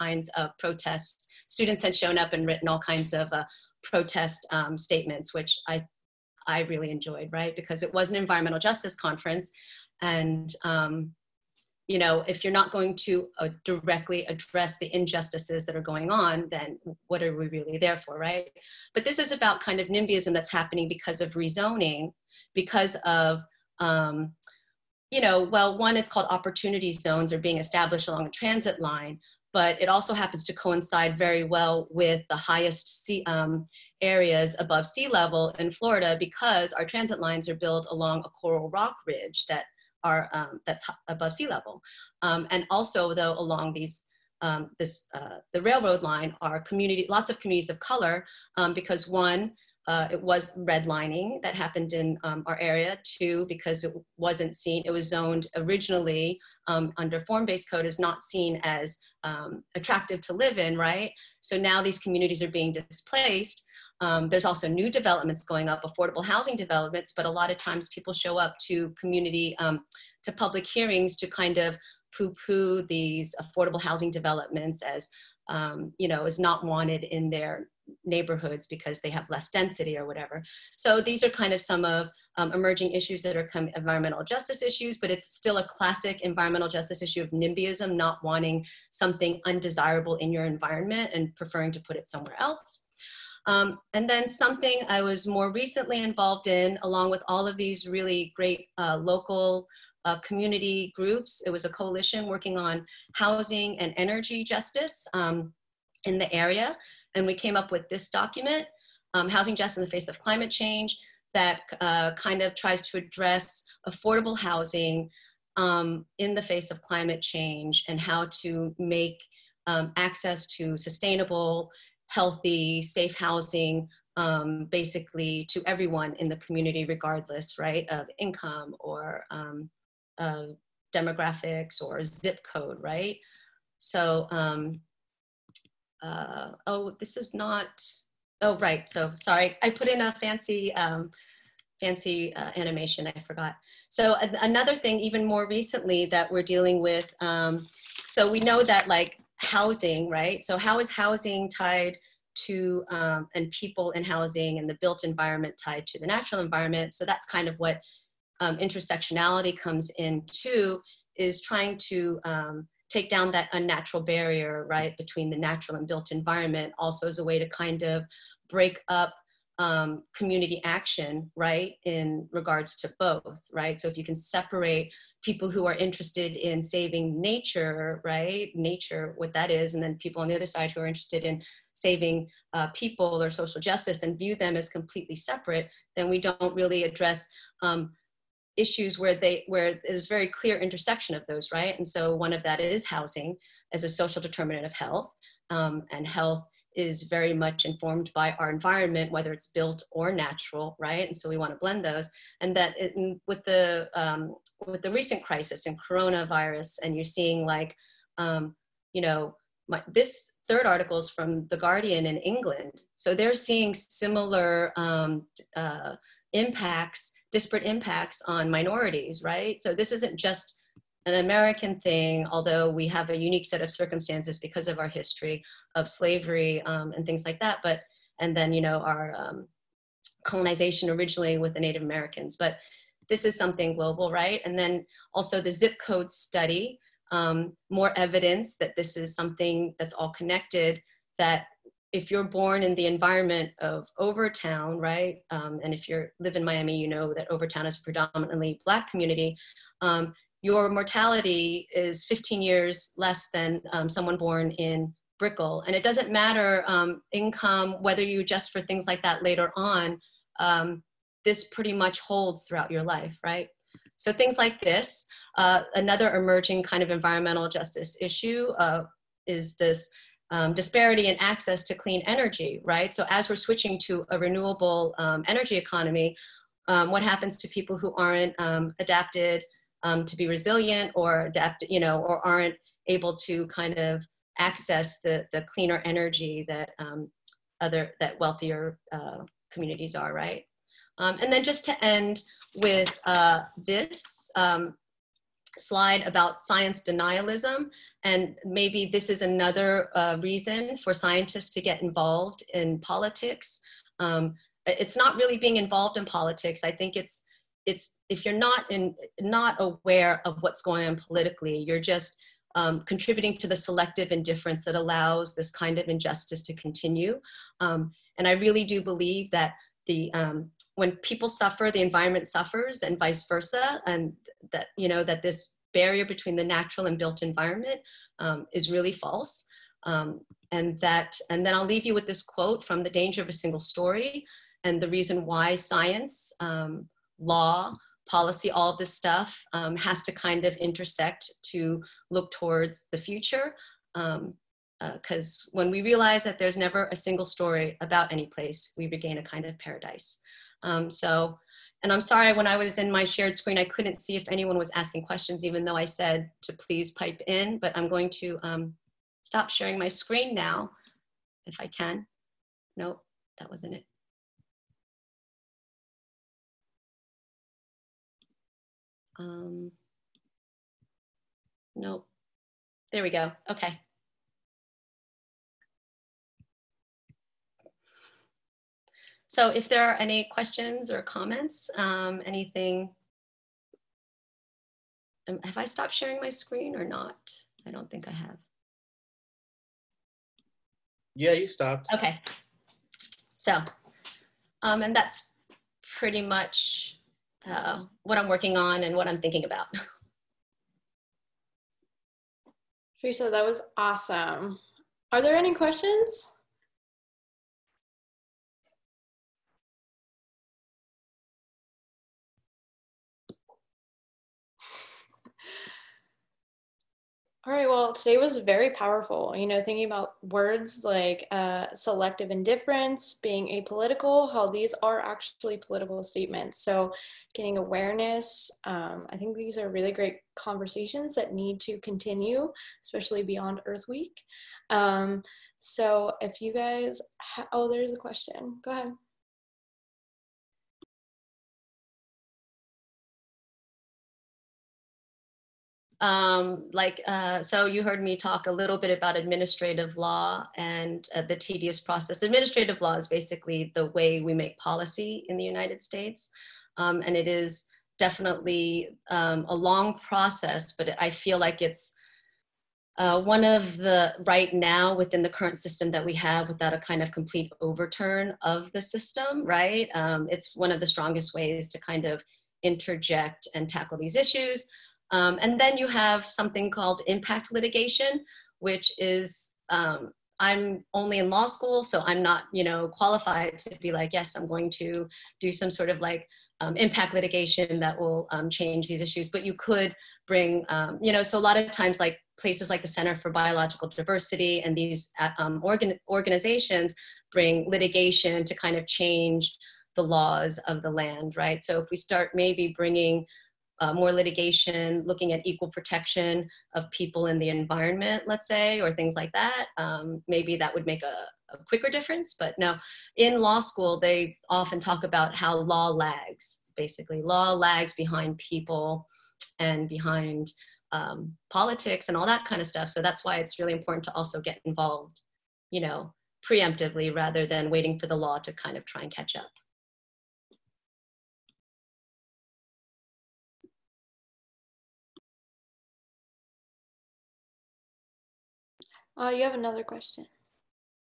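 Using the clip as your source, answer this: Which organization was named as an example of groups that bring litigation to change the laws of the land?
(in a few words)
Center for Biological Diversity.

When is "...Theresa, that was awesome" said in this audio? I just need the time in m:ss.
6:43.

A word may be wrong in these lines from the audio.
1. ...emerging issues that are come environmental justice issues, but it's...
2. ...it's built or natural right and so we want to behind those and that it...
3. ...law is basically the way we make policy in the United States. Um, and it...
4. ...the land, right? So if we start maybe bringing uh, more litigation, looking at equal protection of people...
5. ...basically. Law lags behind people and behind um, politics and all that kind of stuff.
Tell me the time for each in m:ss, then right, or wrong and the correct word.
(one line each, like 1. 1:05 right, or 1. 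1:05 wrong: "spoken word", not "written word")
1. 1:22 right
2. 3:19 wrong: "blend", not "behind"
3. 7:32 right
4. 8:20 right
5. 8:36 right.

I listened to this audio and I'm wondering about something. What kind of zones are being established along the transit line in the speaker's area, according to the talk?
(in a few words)
Opportunity zones.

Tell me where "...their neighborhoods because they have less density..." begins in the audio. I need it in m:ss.
1:17.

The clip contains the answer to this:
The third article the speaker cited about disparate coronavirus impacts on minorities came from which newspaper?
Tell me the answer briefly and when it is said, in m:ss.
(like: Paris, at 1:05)
The Guardian, at 3:31.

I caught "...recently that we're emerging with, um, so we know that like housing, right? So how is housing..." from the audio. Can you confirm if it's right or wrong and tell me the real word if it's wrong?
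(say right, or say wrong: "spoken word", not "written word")
wrong: "dealing", not "emerging".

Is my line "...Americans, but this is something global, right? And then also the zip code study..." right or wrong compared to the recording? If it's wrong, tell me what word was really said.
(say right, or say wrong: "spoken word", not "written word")
right.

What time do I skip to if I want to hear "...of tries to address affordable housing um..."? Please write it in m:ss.
1:52.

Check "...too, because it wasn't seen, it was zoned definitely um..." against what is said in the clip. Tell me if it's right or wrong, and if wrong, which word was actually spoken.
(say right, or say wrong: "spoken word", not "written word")
wrong: "originally", not "definitely".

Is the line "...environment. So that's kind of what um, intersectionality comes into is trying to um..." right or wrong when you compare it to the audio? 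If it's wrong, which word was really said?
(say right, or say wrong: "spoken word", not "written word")
right.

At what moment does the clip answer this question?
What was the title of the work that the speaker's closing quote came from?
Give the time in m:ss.
5:32.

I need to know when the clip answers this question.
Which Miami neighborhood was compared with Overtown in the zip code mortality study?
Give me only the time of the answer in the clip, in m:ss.
4:15.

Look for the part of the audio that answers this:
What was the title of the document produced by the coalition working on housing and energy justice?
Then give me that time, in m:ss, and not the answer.
1:49.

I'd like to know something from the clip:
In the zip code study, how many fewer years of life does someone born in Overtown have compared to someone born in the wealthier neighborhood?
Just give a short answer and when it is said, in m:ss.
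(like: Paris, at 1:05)
15, at 4:12.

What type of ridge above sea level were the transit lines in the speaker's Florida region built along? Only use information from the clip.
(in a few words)
Coral rock ridge.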